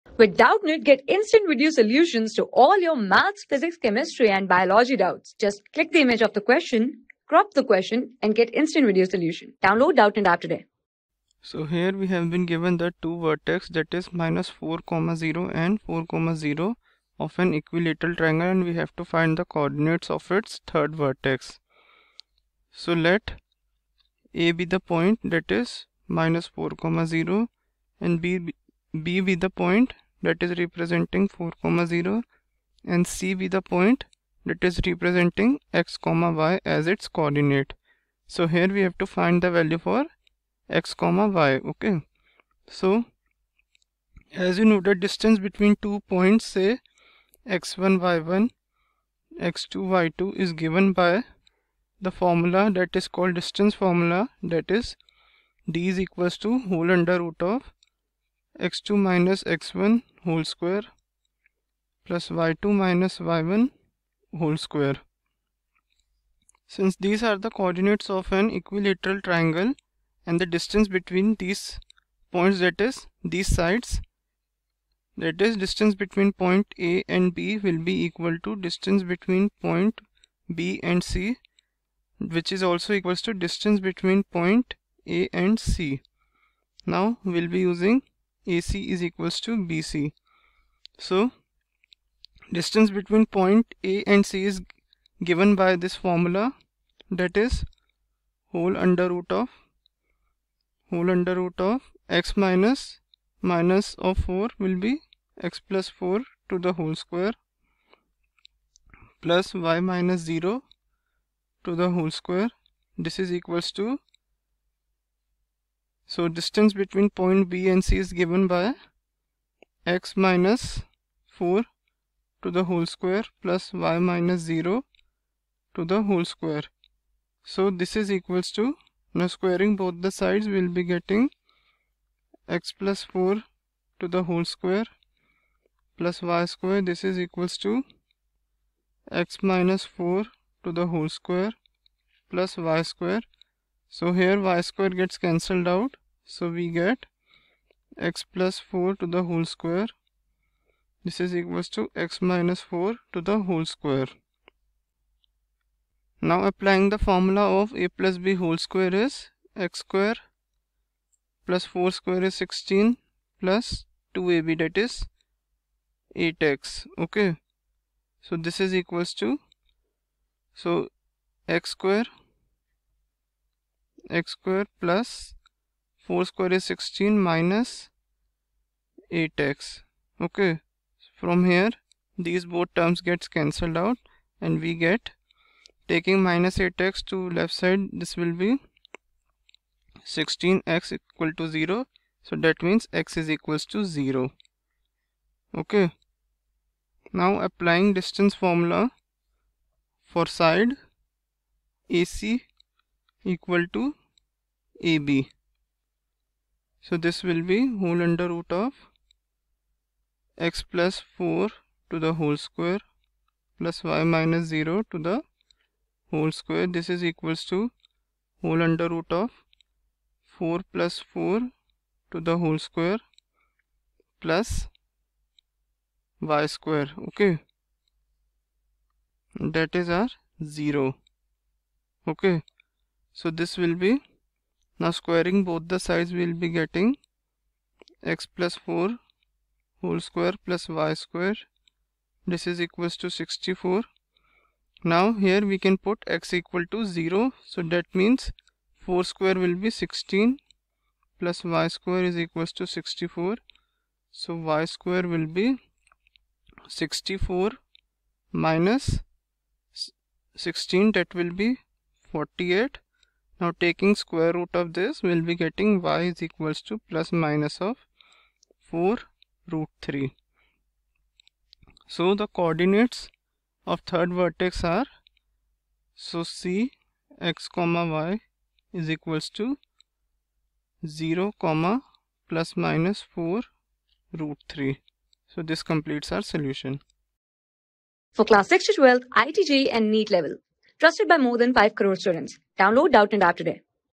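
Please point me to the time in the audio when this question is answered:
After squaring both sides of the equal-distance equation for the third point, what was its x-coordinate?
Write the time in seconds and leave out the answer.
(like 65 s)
192 s.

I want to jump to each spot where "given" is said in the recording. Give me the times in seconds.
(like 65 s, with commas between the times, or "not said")
12 s, 50 s, 95 s, 118 s.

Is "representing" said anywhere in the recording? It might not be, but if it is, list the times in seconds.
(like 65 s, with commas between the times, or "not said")
30 s, 34 s.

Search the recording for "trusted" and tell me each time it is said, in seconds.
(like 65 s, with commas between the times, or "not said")
290 s.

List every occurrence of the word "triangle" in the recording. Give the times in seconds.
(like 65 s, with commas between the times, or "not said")
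18 s, 69 s.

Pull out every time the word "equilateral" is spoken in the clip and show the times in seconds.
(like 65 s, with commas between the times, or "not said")
17 s, 68 s.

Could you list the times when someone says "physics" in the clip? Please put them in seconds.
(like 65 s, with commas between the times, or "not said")
3 s.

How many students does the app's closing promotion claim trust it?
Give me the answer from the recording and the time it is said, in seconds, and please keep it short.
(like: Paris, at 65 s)
5 crore, at 291 s.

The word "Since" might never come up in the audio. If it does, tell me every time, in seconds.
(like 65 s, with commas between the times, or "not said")
66 s.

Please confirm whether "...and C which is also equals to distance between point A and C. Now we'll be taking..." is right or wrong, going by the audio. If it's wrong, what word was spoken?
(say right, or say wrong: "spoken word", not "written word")
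wrong: "using", not "taking".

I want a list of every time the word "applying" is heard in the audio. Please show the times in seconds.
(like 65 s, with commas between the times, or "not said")
156 s, 197 s.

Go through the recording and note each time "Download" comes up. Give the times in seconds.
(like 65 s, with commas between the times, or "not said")
9 s, 292 s.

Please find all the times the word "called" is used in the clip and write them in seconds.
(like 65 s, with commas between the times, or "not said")
53 s.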